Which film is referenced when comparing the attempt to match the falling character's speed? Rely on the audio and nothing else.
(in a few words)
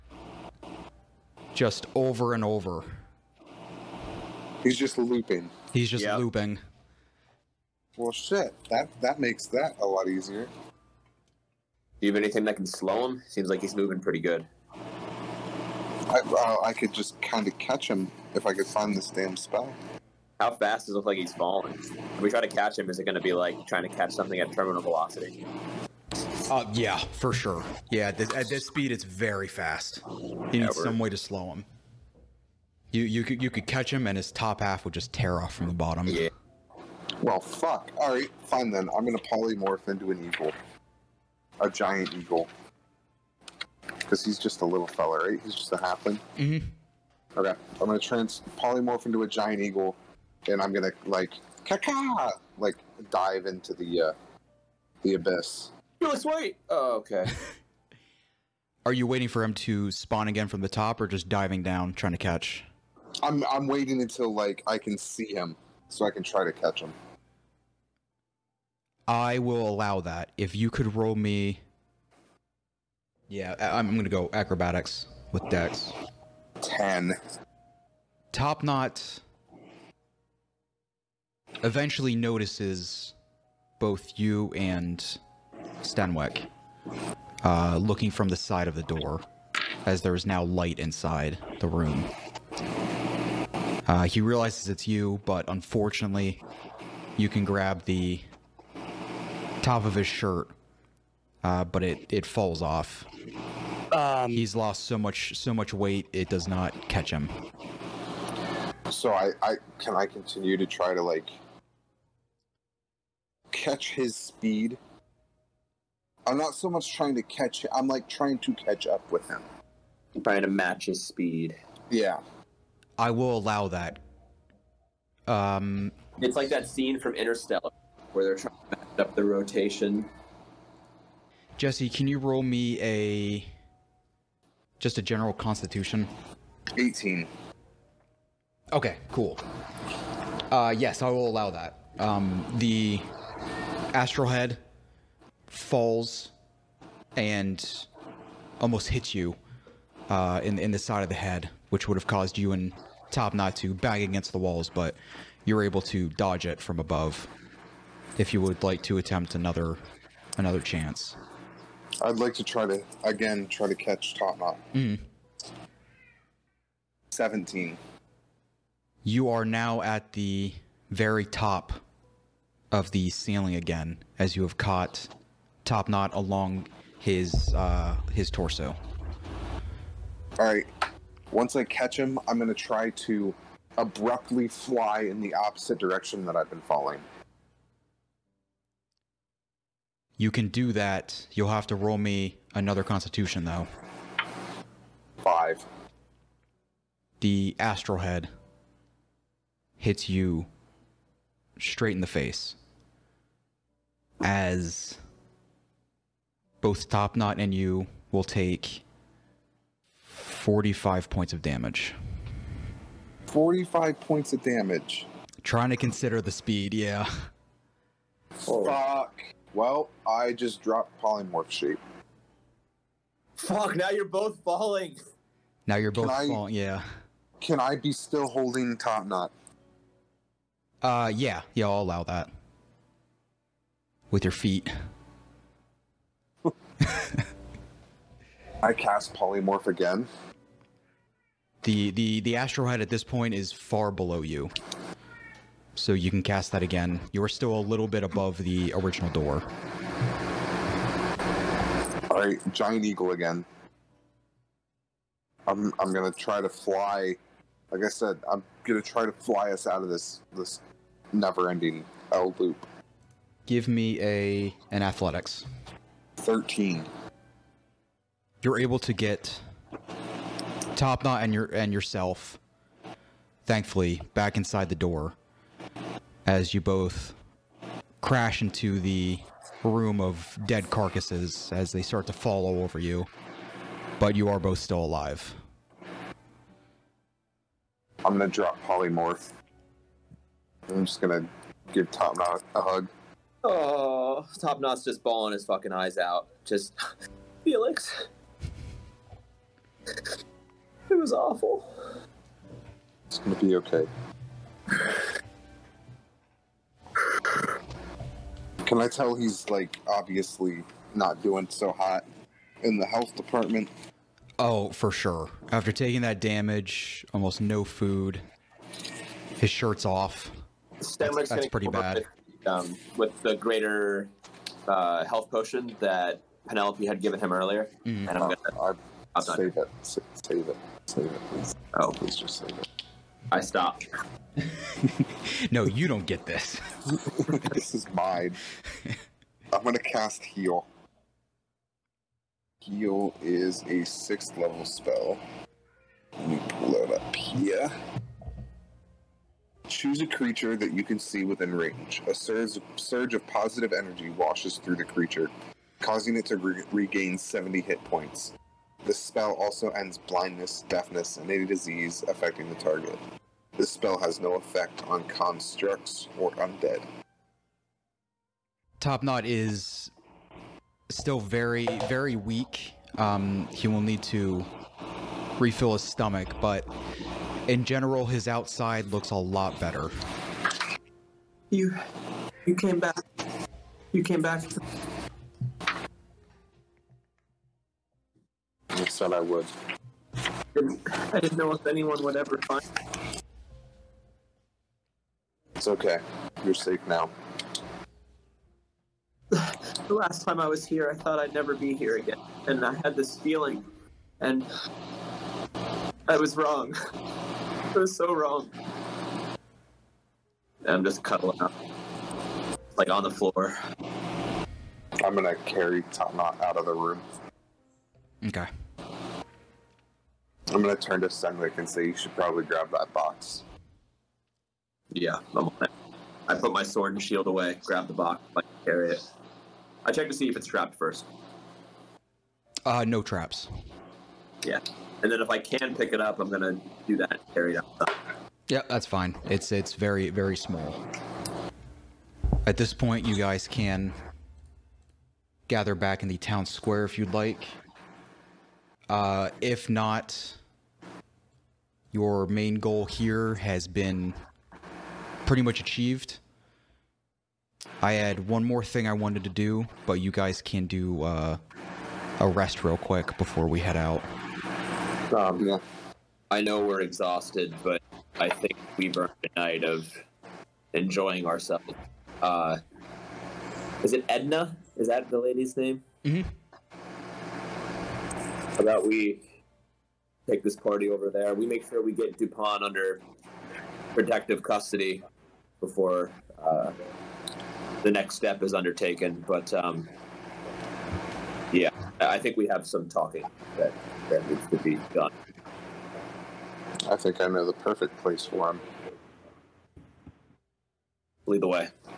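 Interstellar.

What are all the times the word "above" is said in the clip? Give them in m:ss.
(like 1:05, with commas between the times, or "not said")
2:36, 4:08.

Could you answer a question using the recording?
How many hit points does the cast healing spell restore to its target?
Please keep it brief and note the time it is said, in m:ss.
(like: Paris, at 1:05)
70, at 5:57.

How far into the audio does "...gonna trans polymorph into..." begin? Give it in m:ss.
0:47.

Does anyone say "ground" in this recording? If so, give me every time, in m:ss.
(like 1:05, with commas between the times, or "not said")
not said.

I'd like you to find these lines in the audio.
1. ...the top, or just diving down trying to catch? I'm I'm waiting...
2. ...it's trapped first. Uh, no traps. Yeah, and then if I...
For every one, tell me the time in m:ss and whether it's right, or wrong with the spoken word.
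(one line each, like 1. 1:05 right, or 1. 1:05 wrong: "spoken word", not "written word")
1. 1:00 right
2. 7:10 right.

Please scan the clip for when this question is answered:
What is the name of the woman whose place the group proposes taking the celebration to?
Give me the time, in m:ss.
7:54.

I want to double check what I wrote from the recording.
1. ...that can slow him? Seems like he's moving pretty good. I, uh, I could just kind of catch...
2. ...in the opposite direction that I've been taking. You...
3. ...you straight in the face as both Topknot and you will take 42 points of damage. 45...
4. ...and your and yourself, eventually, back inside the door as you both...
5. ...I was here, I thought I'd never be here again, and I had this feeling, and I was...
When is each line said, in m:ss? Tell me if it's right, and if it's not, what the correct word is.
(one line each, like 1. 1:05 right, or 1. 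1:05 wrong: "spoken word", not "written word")
1. 0:12 right
2. 3:05 wrong: "falling", not "taking"
3. 3:20 wrong: "45", not "42"
4. 4:31 wrong: "thankfully", not "eventually"
5. 6:40 right.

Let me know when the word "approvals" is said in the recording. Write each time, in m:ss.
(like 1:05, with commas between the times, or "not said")
not said.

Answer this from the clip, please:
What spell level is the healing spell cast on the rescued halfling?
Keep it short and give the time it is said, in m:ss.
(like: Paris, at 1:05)
Sixth level, at 5:43.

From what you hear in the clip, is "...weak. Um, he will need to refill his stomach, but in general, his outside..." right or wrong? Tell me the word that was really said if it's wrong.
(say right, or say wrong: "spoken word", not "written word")
right.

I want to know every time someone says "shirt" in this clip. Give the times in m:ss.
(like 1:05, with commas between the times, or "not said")
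1:40, 5:19.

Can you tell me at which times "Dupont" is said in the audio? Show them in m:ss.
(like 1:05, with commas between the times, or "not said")
8:02.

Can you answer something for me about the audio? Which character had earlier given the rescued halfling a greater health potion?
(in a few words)
Penelope.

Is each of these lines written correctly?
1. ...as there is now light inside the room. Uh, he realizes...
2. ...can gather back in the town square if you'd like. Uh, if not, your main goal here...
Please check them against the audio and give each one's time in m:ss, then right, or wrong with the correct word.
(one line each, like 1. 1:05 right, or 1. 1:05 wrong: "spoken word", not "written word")
1. 1:29 right
2. 7:23 right.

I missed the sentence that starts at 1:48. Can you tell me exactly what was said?
So I, I can I continue to try to like catch his speed.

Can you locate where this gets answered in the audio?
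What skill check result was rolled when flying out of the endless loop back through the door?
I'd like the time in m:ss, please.
4:26.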